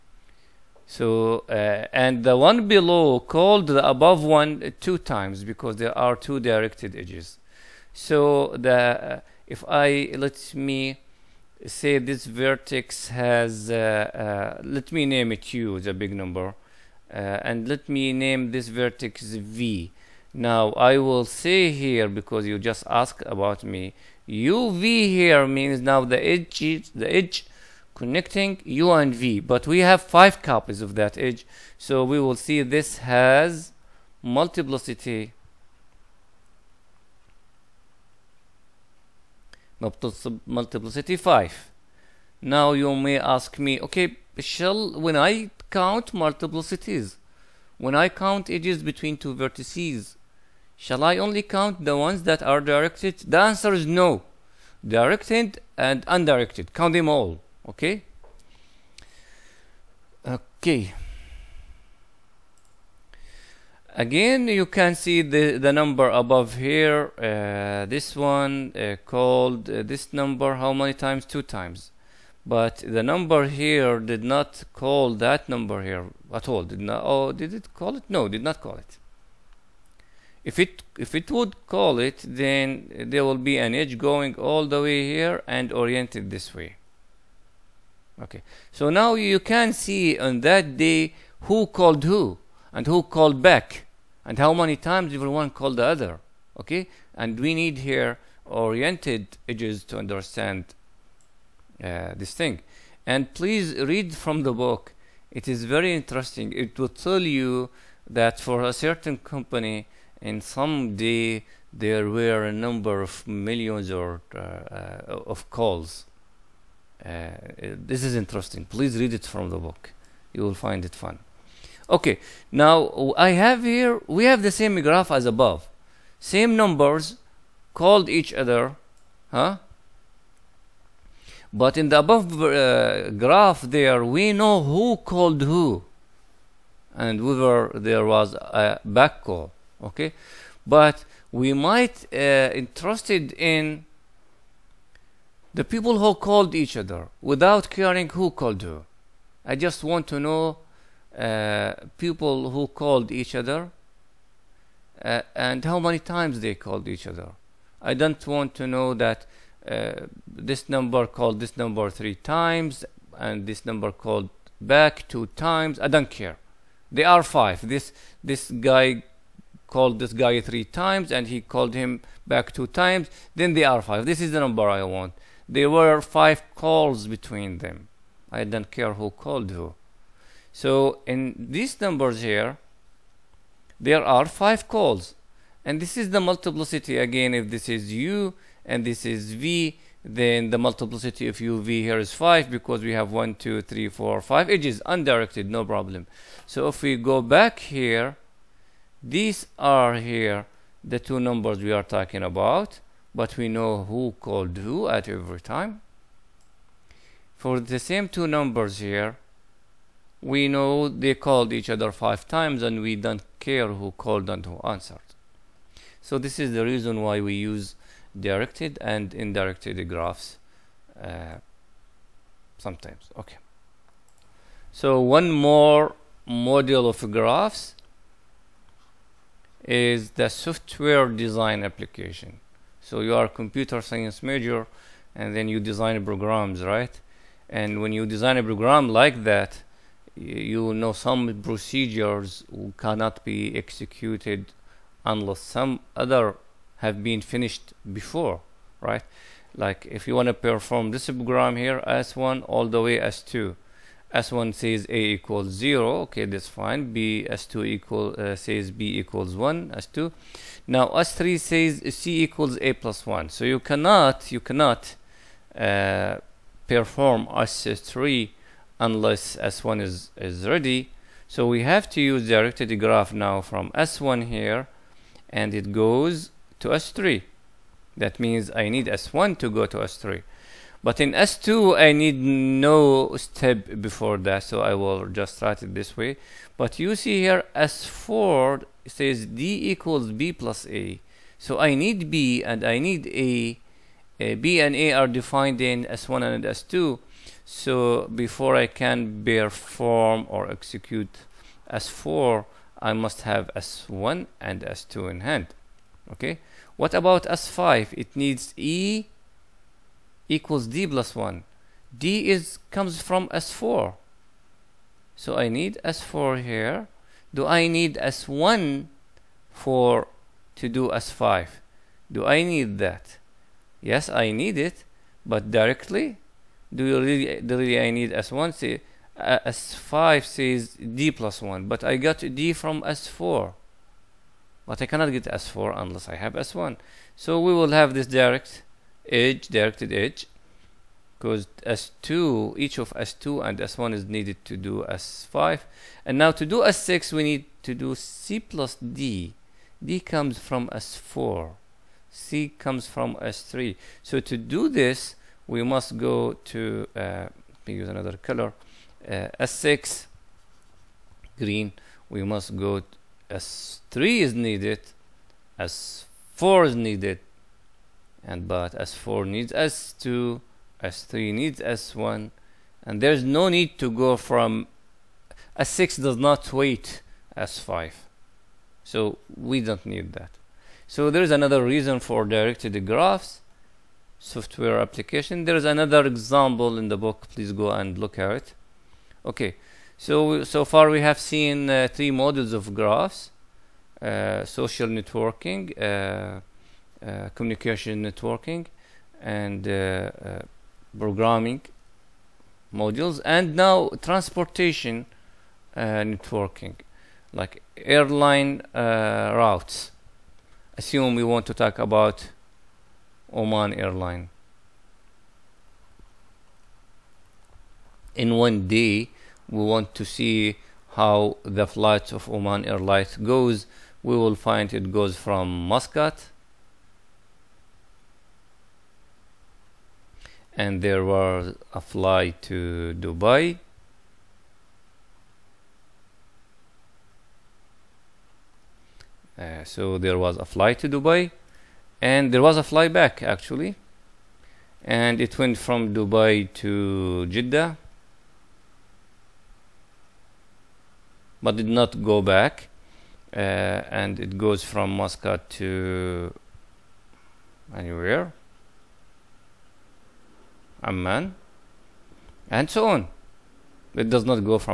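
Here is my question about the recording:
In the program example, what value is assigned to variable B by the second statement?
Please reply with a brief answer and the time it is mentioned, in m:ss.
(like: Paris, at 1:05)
1, at 4:18.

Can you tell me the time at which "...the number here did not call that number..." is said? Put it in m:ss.
1:12.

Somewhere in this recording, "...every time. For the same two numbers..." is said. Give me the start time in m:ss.
3:25.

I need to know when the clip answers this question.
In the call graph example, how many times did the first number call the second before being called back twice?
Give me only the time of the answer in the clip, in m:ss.
2:40.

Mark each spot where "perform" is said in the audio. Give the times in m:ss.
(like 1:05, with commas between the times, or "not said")
4:10, 4:26, 4:59.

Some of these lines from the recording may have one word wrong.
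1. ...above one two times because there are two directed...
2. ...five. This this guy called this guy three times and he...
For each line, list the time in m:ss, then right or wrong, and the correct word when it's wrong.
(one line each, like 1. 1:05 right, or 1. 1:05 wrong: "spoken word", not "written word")
1. 0:03 right
2. 2:47 right.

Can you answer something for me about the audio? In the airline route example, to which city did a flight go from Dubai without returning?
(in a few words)
Jeddah.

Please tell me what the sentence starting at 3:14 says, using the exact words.
It is edges undirected, no problem.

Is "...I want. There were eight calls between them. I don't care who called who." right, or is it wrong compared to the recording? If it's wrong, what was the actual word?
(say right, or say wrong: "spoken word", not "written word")
wrong: "five", not "eight".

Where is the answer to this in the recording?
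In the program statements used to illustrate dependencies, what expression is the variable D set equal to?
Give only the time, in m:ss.
4:49.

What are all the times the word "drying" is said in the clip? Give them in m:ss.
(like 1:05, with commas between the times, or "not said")
not said.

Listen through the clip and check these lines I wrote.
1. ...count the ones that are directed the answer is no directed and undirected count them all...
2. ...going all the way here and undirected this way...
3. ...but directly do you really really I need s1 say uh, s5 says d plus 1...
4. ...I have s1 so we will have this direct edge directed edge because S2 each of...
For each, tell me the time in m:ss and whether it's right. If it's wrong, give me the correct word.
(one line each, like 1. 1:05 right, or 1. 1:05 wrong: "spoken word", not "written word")
1. 0:51 right
2. 1:23 wrong: "oriented", not "undirected"
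3. 5:25 right
4. 5:36 right.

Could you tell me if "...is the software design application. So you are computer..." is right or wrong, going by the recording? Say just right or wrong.
right.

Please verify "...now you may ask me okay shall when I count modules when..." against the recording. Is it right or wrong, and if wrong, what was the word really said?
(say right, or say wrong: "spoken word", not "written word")
wrong: "multiplicities", not "modules".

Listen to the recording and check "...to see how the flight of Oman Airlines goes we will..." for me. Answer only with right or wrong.
right.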